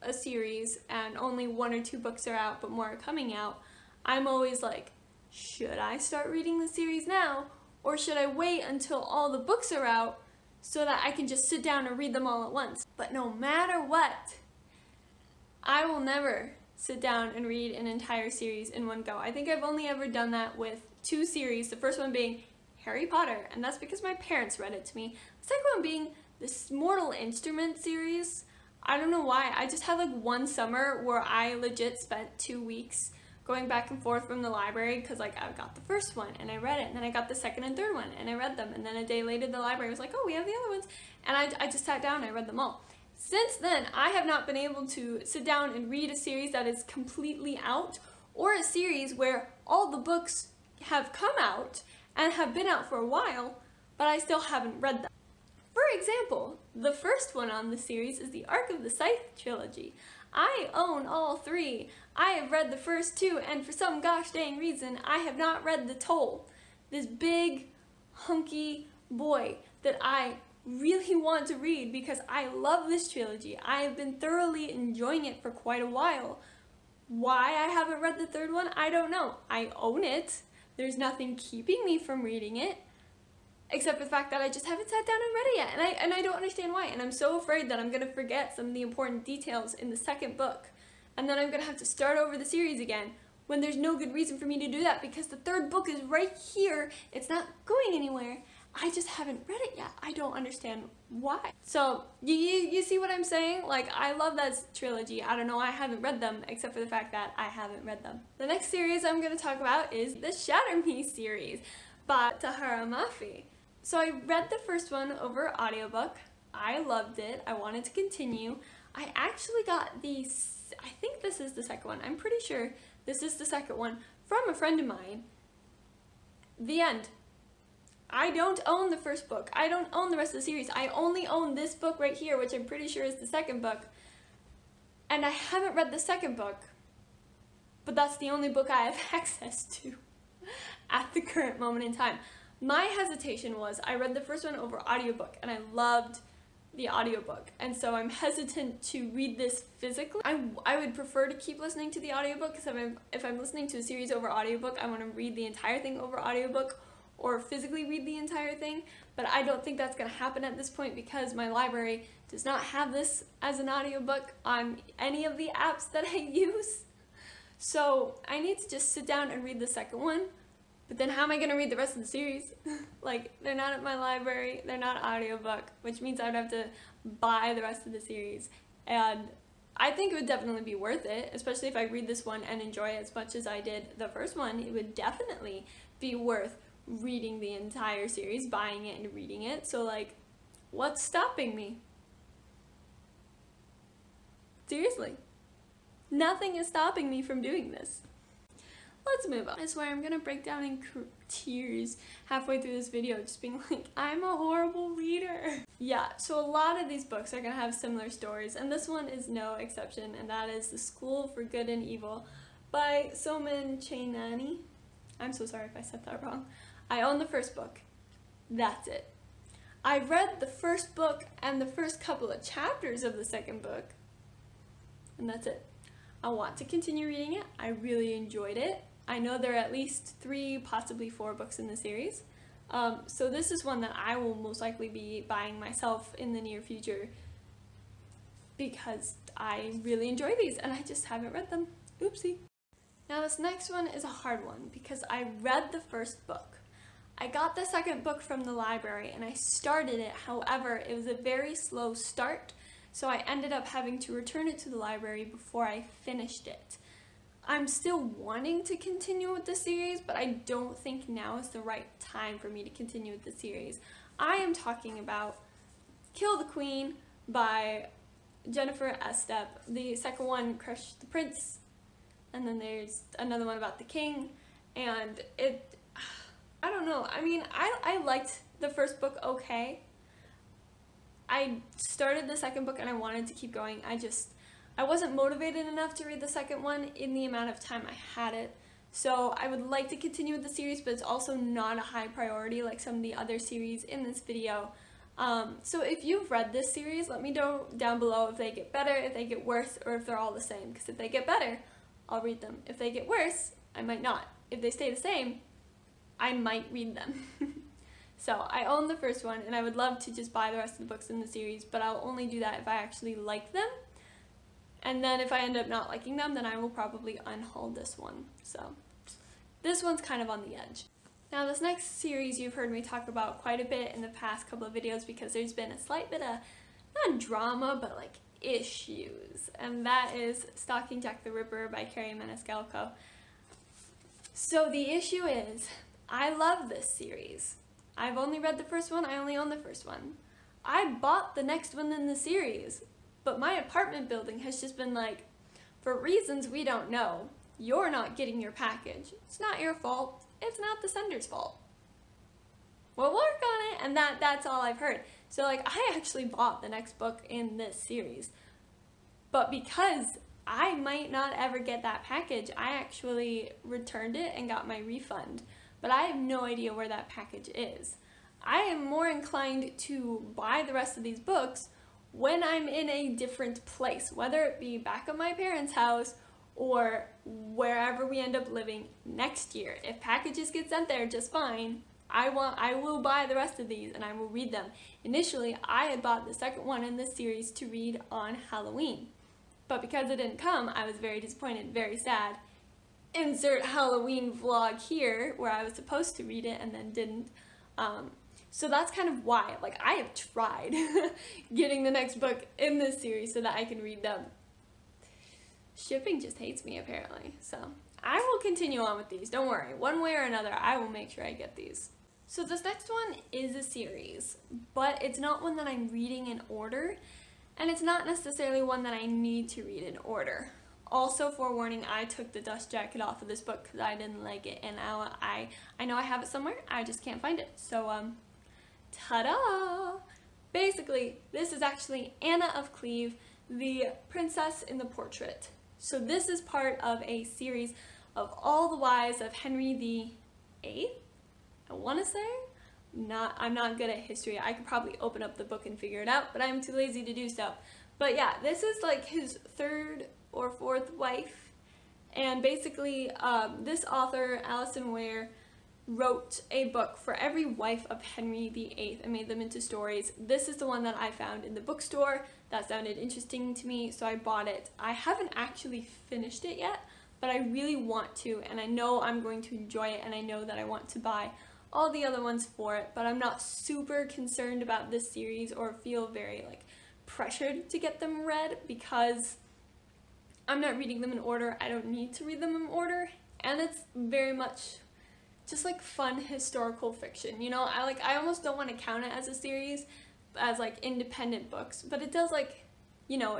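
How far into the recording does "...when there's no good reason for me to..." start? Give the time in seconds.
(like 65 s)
93 s.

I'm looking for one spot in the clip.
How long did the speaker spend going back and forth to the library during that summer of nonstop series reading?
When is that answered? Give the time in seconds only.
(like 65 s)
32 s.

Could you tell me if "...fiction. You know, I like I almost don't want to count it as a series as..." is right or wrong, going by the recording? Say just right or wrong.
right.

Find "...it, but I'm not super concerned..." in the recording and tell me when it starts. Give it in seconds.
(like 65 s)
472 s.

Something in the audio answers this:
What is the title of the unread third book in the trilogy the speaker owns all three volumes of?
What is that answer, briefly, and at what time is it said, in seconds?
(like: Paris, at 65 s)
The Toll, at 65 s.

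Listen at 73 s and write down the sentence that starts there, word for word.
I have been thoroughly enjoying it for quite a while.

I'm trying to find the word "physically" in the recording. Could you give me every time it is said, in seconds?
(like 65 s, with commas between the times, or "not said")
149 s, 157 s.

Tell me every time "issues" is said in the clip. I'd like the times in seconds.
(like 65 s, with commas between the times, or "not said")
328 s, 334 s.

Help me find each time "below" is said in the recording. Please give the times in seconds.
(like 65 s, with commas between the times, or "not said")
298 s.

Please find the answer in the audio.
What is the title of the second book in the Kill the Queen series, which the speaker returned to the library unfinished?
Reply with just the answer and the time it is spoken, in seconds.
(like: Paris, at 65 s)
Crush the Prince, at 270 s.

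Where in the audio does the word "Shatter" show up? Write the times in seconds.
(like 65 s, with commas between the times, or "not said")
110 s.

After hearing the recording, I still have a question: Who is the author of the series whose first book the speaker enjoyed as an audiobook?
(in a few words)
Tahereh Mafi.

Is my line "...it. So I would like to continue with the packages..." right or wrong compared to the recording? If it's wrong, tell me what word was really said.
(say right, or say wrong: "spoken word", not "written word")
wrong: "series", not "packages".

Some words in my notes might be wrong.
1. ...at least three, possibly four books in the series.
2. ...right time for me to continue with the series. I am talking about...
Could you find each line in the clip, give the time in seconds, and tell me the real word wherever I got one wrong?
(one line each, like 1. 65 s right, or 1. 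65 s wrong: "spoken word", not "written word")
1. 229 s right
2. 261 s right.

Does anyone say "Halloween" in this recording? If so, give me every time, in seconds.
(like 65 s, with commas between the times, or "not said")
388 s, 393 s.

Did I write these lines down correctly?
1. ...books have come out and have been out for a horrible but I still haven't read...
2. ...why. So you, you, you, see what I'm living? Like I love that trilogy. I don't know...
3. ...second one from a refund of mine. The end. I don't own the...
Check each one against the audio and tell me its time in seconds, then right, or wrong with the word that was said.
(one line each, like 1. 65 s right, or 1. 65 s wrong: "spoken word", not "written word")
1. 49 s wrong: "while", not "horrible"
2. 101 s wrong: "saying", not "living"
3. 123 s wrong: "friend", not "refund".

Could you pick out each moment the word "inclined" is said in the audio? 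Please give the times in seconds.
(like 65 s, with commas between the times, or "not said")
369 s.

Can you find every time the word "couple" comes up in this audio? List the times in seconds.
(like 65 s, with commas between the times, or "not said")
222 s, 324 s.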